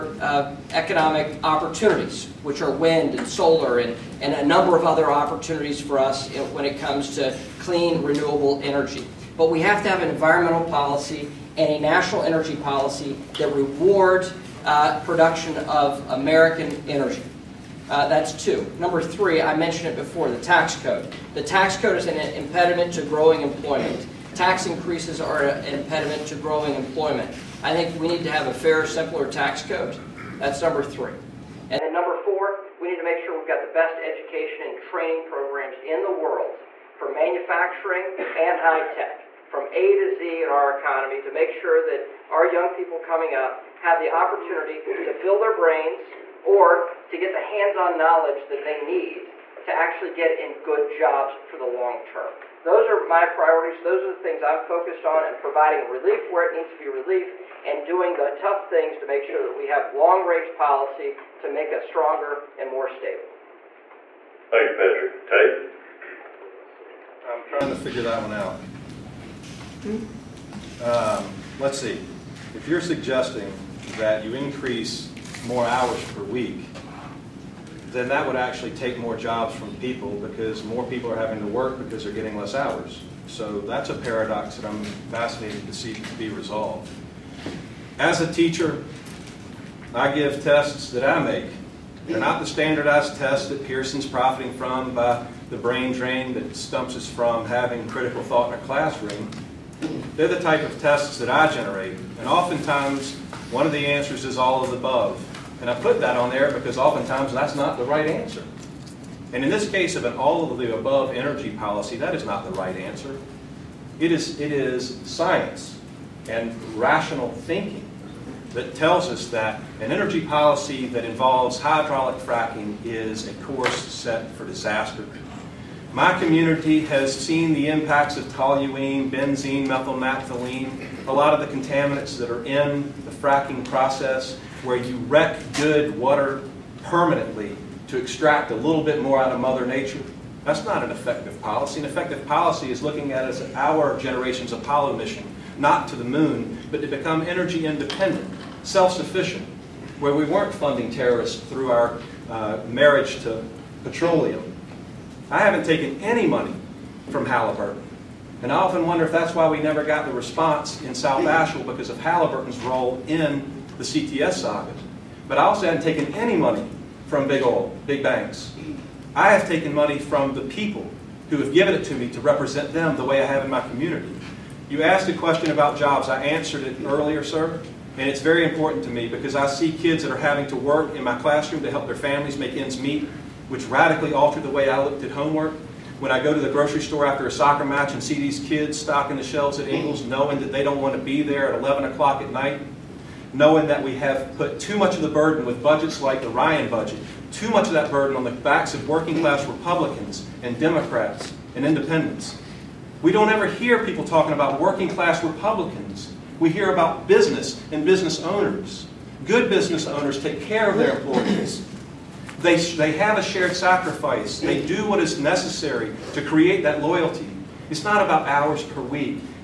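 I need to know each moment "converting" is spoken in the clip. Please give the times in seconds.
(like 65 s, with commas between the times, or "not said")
not said.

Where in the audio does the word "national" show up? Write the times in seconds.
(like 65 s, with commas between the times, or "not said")
11 s.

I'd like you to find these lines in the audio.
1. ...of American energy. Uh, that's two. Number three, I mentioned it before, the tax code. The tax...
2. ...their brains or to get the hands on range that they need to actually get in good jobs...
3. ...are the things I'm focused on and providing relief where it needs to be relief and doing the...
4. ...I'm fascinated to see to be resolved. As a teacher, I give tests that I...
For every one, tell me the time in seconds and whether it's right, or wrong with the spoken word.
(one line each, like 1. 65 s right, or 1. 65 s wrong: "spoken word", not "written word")
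1. 15 s right
2. 45 s wrong: "knowledge", not "range"
3. 54 s right
4. 84 s right.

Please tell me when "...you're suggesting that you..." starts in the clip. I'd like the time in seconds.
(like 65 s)
72 s.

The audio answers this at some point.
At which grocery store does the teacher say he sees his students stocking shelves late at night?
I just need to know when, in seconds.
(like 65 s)
189 s.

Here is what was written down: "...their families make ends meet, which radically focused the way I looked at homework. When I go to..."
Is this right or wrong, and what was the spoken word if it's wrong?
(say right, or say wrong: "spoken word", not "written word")
wrong: "altered", not "focused".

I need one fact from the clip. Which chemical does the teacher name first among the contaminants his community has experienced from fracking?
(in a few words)
toluene.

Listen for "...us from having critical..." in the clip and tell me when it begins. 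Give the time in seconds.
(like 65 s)
96 s.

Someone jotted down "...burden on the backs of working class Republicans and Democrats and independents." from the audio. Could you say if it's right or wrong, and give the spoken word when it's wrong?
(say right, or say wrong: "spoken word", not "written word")
right.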